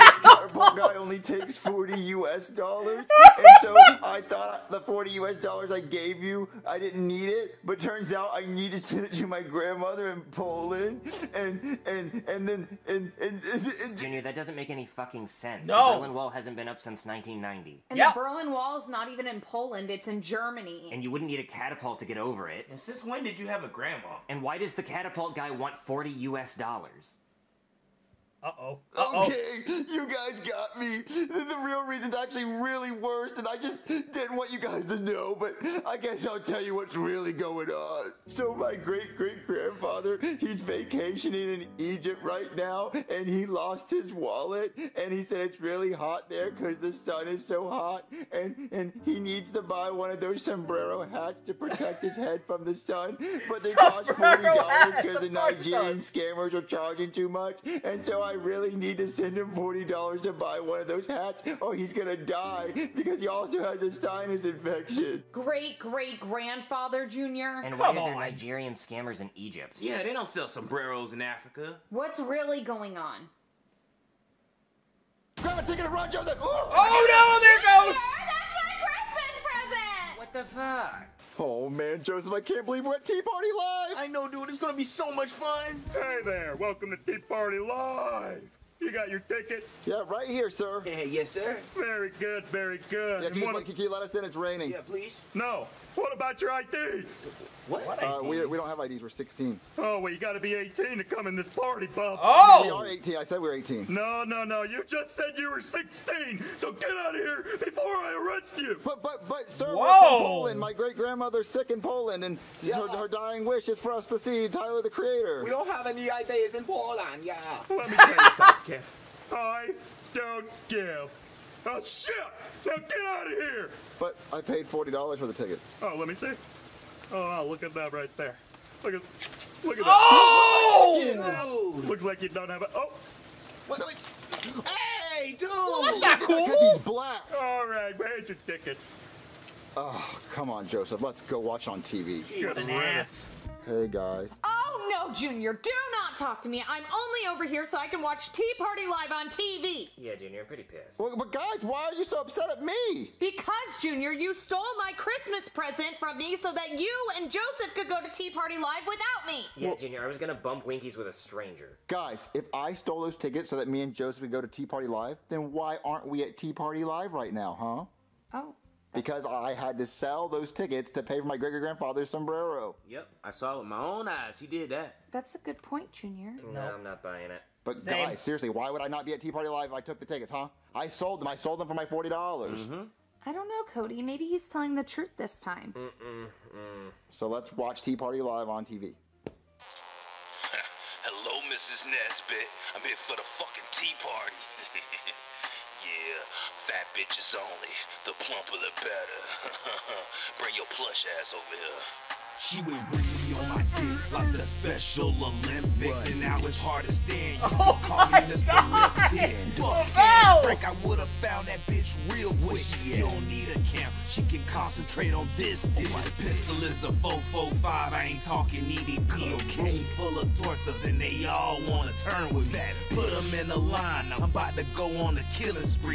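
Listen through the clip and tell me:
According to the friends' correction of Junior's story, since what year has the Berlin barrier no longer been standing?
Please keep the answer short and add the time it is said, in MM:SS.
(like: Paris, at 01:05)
1990, at 00:17.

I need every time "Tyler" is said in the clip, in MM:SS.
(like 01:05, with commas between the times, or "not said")
01:54.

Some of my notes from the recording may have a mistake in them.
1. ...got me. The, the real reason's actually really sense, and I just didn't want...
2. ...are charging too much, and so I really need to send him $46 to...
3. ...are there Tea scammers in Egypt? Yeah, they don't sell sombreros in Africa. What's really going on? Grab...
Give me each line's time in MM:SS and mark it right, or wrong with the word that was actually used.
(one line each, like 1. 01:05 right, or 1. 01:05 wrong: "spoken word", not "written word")
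1. 00:30 wrong: "worse", not "sense"
2. 00:56 wrong: "40", not "46"
3. 01:08 wrong: "Nigerian", not "Tea".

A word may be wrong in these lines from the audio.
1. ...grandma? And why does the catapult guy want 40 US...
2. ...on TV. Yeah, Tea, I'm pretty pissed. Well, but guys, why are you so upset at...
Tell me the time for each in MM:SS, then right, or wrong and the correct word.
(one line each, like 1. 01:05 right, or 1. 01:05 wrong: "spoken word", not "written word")
1. 00:23 right
2. 02:29 wrong: "Junior", not "Tea".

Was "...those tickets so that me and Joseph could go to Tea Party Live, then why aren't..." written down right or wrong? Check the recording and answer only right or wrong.
right.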